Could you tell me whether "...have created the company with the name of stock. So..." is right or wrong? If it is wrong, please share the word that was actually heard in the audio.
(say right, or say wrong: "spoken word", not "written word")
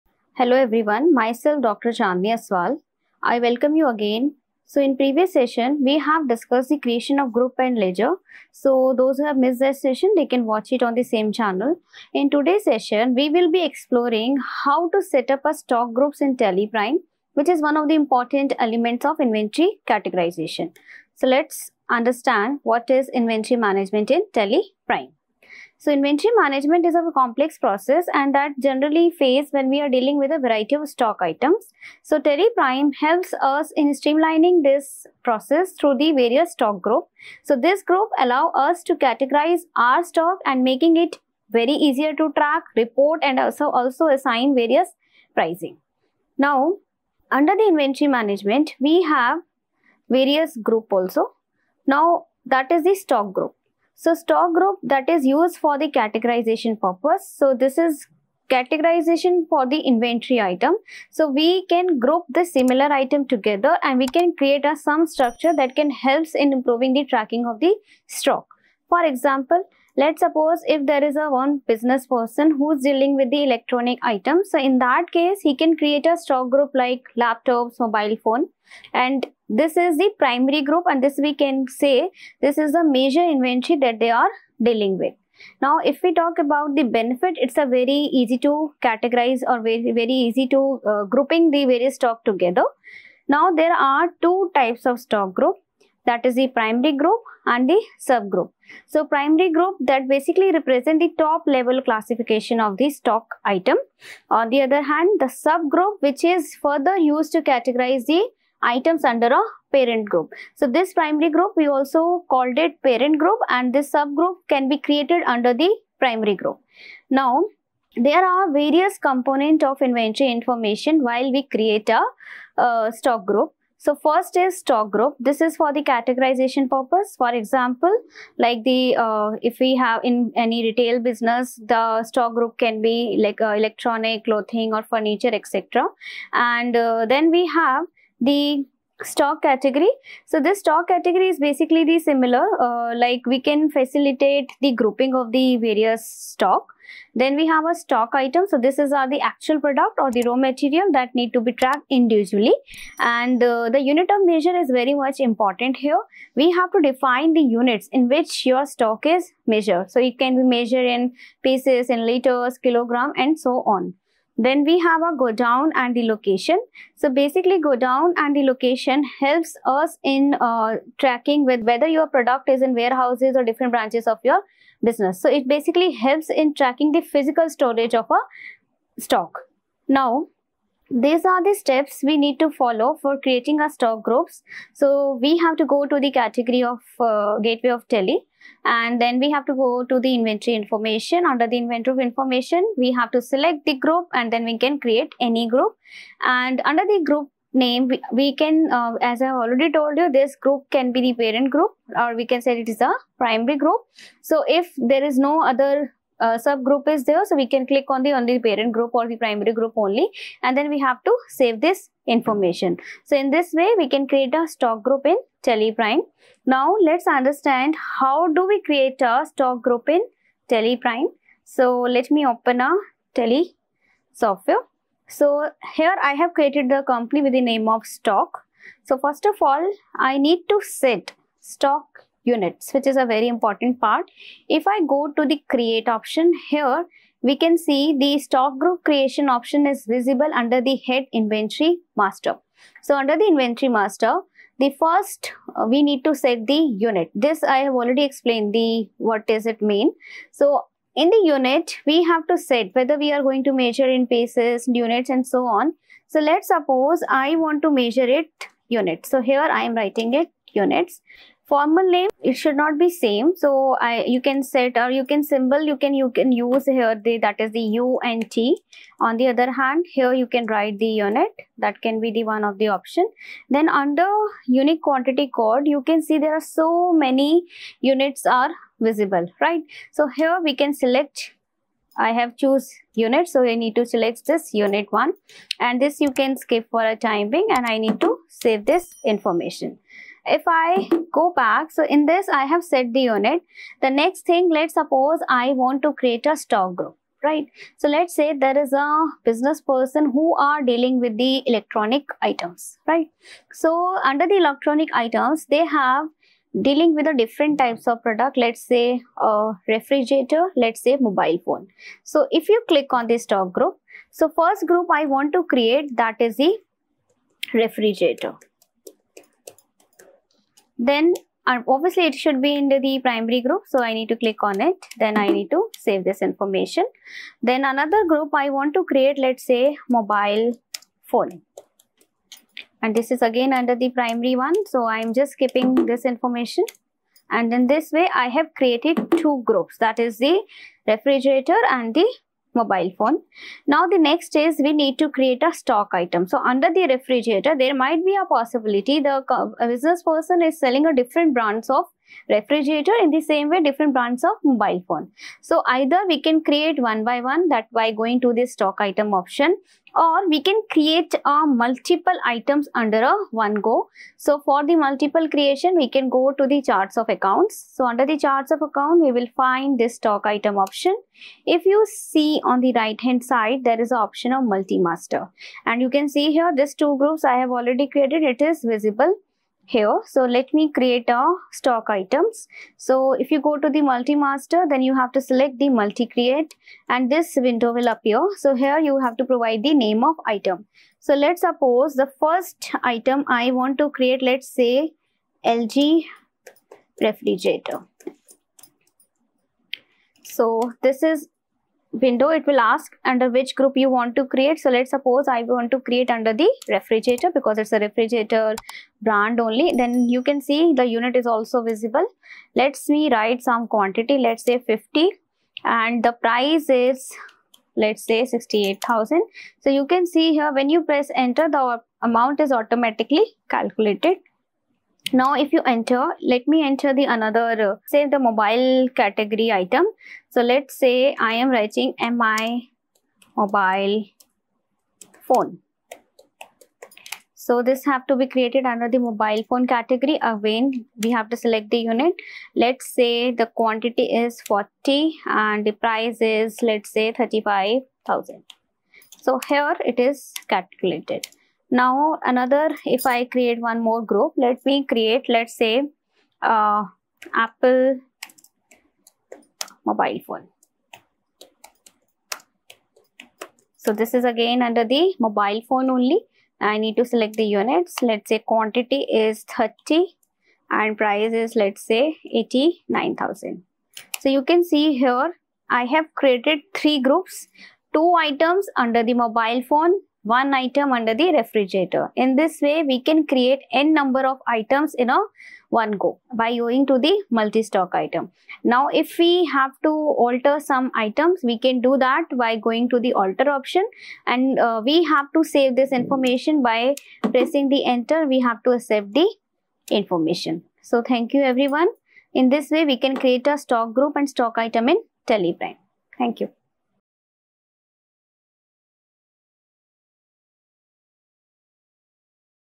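right.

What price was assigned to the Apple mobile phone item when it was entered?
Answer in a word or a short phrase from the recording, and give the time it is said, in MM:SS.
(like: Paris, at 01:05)
89000, at 07:52.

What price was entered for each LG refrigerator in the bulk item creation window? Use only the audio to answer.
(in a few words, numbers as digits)
68000.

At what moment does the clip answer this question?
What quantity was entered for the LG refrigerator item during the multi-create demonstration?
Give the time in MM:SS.
06:54.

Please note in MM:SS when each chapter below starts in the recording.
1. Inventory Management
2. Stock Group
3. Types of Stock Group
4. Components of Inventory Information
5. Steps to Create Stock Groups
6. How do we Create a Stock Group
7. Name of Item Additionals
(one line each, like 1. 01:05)
1. 00:21
2. 00:52
3. 01:32
4. 01:57
5. 03:00
6. 03:38
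7. 06:18.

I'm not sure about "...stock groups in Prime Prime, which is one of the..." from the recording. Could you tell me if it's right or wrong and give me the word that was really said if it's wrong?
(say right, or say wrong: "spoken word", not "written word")
wrong: "Tally", not "Prime".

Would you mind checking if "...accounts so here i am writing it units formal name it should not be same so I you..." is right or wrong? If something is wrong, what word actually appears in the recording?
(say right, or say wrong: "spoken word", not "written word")
wrong: "units", not "accounts".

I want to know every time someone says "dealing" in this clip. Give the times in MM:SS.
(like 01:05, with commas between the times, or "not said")
00:29, 01:12, 01:24, 05:00, 05:06.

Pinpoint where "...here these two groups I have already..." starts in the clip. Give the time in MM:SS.
06:16.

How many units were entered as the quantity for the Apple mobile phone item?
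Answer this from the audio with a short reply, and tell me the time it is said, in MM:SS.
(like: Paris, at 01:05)
30, at 07:48.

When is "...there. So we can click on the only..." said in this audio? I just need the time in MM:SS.
03:27.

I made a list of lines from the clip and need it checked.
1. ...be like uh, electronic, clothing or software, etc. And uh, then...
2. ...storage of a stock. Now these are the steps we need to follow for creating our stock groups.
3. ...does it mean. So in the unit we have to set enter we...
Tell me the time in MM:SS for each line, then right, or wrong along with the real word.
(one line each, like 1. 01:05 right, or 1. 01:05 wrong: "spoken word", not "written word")
1. 02:12 wrong: "furniture", not "software"
2. 02:57 right
3. 04:09 wrong: "whether", not "enter".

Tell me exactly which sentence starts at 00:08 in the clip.
So those who have missed that session, they can watch it on the same channel.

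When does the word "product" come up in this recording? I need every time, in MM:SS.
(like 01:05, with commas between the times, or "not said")
02:29, 02:52, 05:08.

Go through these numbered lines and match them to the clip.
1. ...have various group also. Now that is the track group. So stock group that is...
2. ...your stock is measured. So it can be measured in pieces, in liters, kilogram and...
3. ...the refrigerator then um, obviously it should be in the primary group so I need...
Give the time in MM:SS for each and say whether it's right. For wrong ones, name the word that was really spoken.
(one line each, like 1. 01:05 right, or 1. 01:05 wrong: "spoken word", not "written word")
1. 00:49 wrong: "stock", not "track"
2. 02:38 right
3. 05:16 right.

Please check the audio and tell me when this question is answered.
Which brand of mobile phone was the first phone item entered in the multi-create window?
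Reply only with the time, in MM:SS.
07:12.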